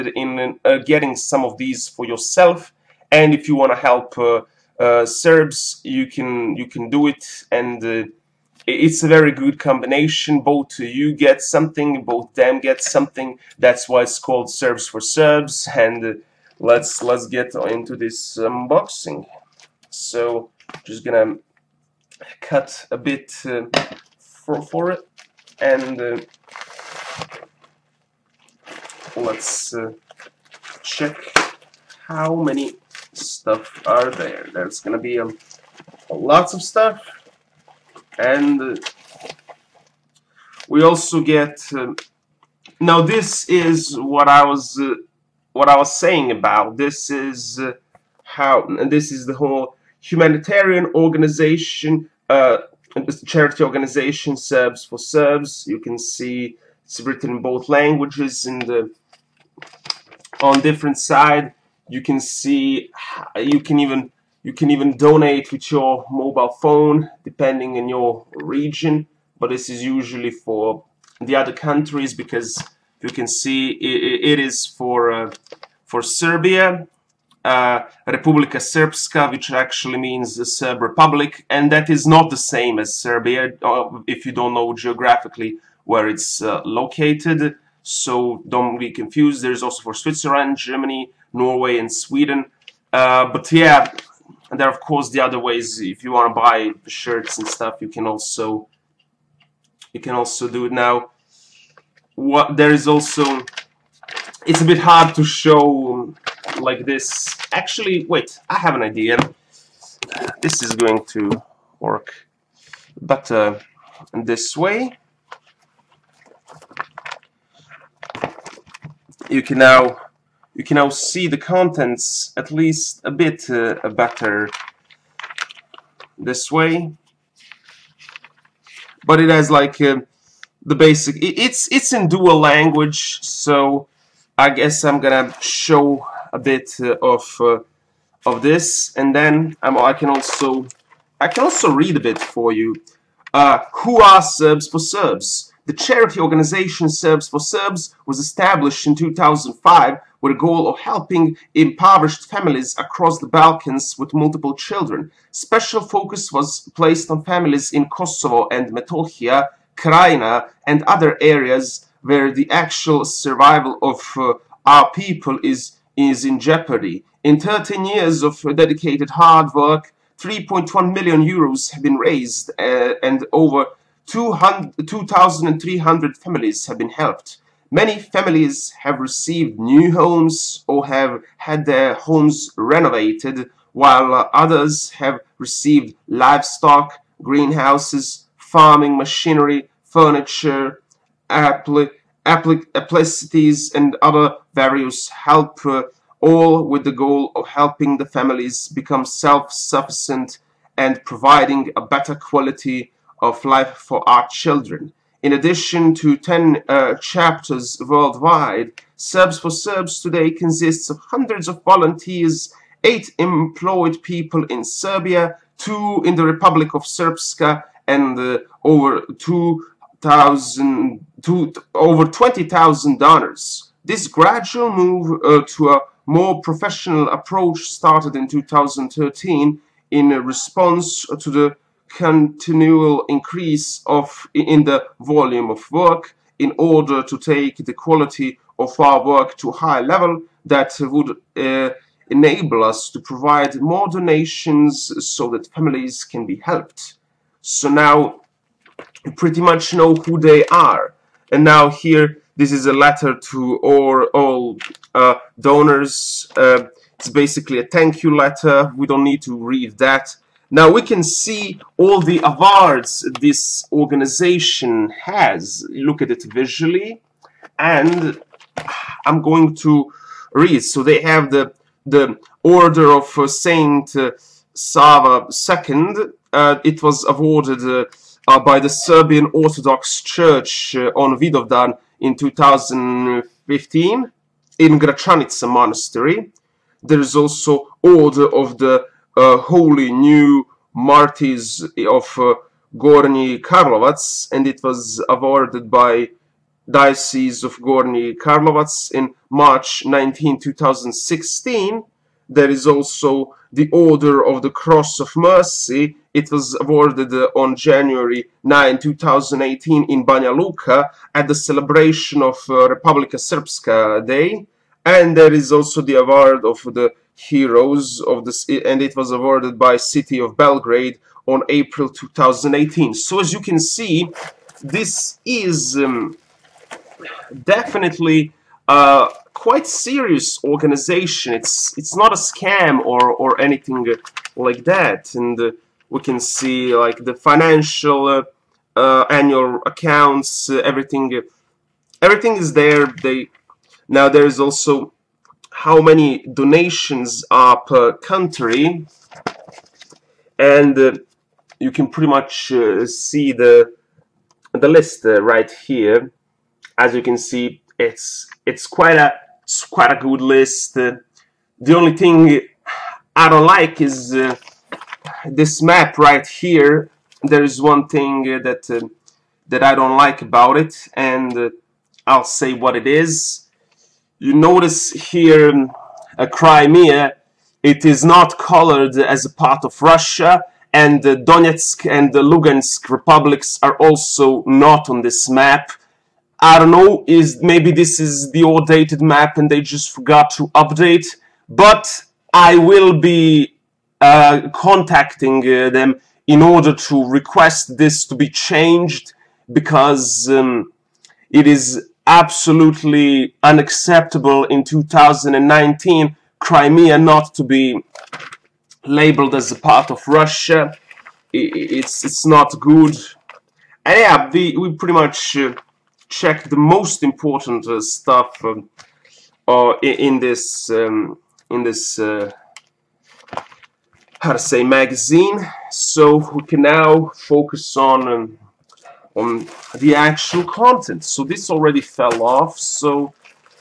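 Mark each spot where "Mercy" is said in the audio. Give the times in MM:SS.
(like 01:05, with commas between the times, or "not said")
05:05.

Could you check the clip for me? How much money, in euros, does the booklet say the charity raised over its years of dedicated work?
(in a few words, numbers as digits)
3.1 million euros.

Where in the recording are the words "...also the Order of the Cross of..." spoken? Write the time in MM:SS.
05:02.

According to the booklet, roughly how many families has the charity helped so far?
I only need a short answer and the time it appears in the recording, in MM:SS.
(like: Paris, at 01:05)
over 2,300, at 02:53.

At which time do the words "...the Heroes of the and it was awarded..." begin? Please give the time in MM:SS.
05:16.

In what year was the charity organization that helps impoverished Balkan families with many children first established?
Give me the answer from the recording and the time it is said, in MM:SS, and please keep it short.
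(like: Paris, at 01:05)
2005, at 02:28.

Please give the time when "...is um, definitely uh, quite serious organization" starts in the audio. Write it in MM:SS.
05:25.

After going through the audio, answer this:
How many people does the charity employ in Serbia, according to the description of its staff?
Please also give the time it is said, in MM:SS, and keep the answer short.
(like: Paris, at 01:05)
8, at 03:32.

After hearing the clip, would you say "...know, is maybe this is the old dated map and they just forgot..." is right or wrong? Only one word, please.
right.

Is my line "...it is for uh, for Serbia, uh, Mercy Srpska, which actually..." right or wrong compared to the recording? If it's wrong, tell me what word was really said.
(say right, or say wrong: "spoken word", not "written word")
wrong: "Republika", not "Mercy".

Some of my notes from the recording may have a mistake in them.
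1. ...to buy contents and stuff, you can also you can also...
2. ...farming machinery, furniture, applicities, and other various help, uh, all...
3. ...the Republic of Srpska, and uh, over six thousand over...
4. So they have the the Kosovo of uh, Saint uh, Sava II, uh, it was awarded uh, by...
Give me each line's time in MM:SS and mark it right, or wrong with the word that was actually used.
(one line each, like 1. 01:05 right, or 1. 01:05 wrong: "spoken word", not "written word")
1. 01:36 wrong: "shirts", not "contents"
2. 03:08 right
3. 03:36 wrong: "two", not "six"
4. 04:30 wrong: "Order", not "Kosovo".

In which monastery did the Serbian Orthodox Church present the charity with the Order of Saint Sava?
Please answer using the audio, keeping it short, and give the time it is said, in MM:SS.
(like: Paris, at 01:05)
Gračanica Monastery, at 04:44.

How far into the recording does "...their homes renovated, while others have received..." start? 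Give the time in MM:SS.
03:01.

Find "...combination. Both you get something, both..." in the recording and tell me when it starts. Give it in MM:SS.
00:09.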